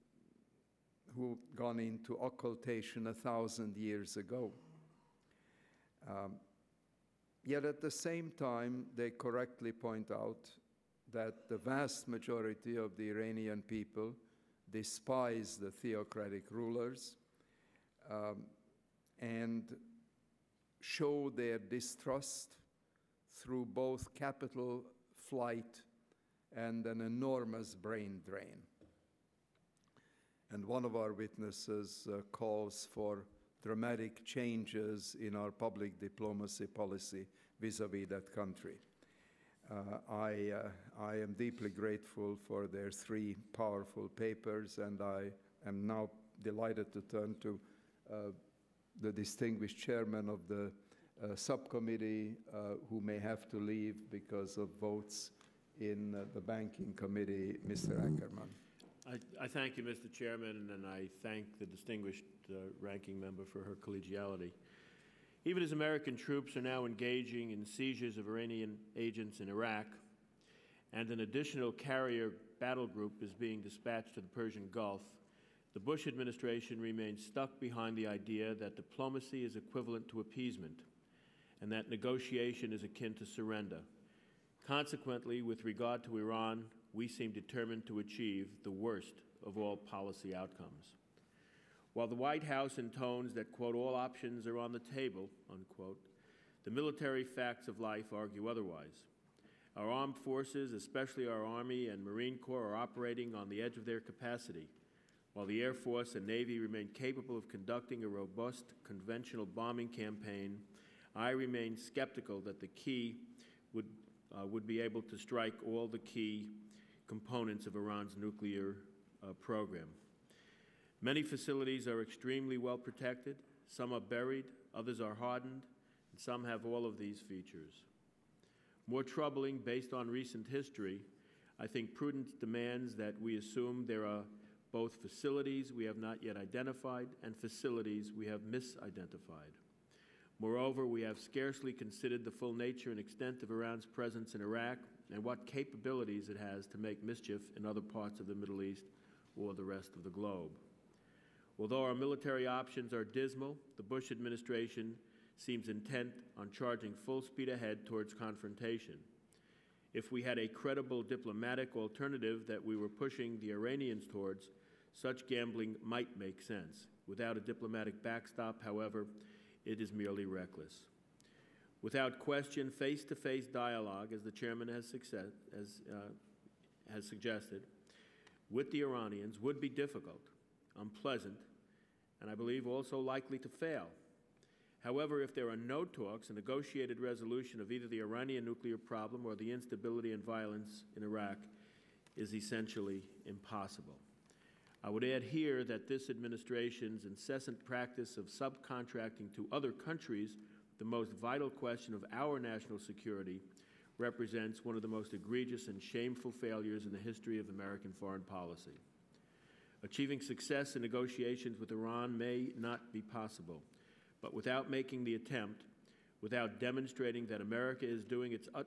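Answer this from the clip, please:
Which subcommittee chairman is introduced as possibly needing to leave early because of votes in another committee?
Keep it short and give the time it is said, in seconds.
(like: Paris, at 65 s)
Mr. Ackerman, at 57 s.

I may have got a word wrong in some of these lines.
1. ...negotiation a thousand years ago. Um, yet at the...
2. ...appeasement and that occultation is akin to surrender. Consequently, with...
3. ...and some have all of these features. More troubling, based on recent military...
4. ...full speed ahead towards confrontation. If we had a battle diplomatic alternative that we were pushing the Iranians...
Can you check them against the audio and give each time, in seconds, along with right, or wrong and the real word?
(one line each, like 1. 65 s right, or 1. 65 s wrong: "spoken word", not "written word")
1. 2 s wrong: "occultation", not "negotiation"
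2. 80 s wrong: "negotiation", not "occultation"
3. 126 s wrong: "history", not "military"
4. 156 s wrong: "credible", not "battle".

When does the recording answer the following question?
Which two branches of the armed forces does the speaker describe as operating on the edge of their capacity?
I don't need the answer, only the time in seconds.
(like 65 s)
101 s.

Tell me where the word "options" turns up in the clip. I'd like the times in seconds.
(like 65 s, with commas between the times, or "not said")
93 s, 152 s.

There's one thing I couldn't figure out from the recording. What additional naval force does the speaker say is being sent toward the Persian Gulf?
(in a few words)
carrier battle group.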